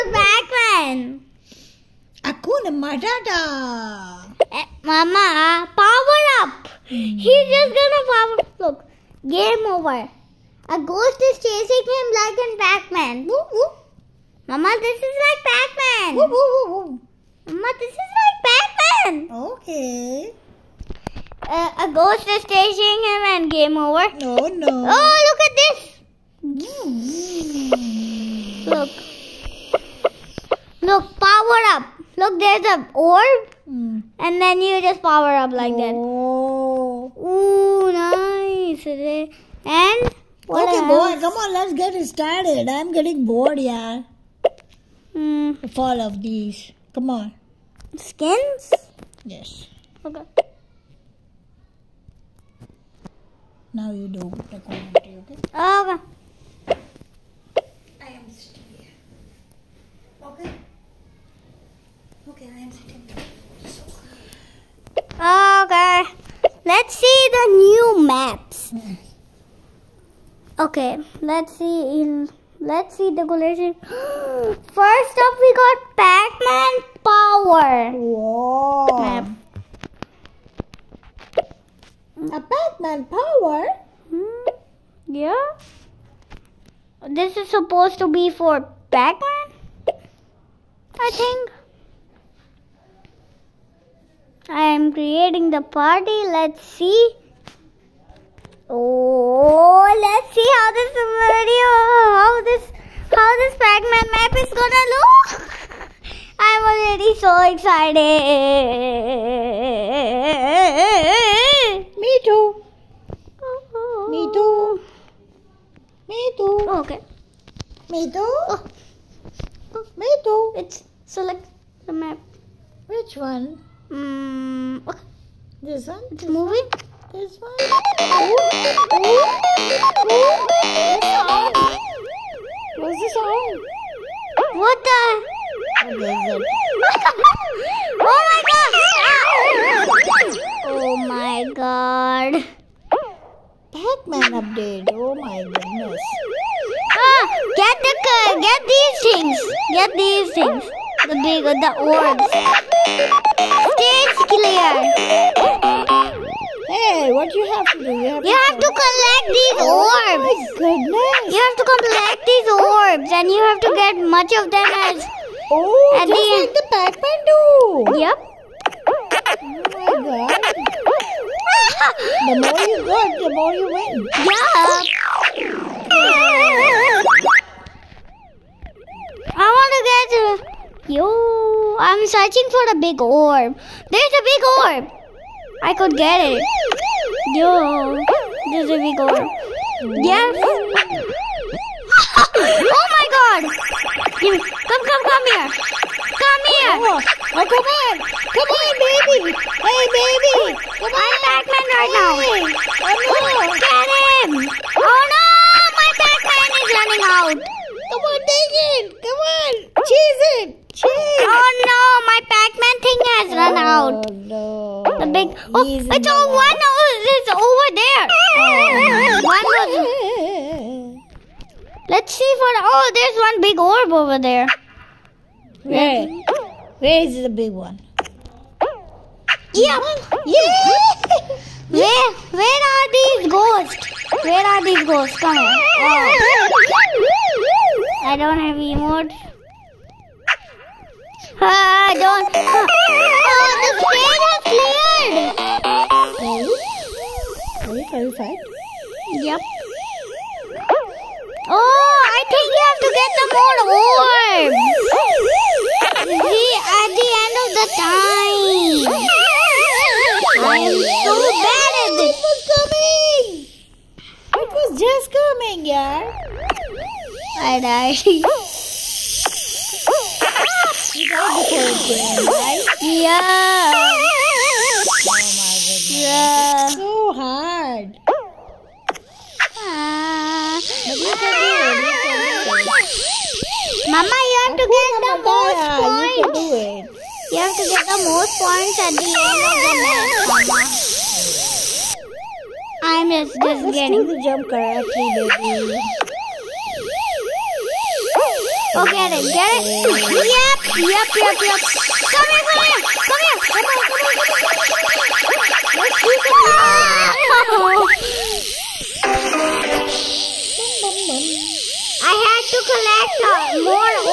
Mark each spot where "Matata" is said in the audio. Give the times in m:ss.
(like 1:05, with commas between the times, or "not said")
0:02.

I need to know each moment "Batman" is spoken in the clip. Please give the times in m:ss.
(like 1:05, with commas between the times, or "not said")
0:00, 3:26.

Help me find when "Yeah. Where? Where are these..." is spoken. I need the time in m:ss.
3:50.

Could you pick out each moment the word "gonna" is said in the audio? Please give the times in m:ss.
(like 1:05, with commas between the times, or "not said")
0:07, 1:44.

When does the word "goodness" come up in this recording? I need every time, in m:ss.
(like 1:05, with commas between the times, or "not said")
2:25, 2:40.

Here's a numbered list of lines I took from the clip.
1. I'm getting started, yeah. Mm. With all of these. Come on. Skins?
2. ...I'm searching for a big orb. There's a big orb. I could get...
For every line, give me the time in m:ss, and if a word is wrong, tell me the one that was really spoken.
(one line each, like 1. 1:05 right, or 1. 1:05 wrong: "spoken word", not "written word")
1. 0:42 wrong: "bored", not "started"
2. 3:01 right.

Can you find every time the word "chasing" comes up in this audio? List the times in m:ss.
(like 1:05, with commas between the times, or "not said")
0:11, 0:22.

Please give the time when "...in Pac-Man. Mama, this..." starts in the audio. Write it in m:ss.
0:12.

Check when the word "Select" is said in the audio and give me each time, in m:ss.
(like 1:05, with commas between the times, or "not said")
2:01.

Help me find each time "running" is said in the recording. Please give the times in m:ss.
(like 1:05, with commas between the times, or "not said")
3:26.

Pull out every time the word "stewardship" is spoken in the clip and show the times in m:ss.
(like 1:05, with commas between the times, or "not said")
not said.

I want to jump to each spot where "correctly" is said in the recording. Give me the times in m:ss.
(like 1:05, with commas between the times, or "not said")
4:54.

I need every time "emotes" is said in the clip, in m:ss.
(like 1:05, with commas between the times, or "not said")
3:58.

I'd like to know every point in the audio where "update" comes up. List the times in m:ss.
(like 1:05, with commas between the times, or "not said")
2:24.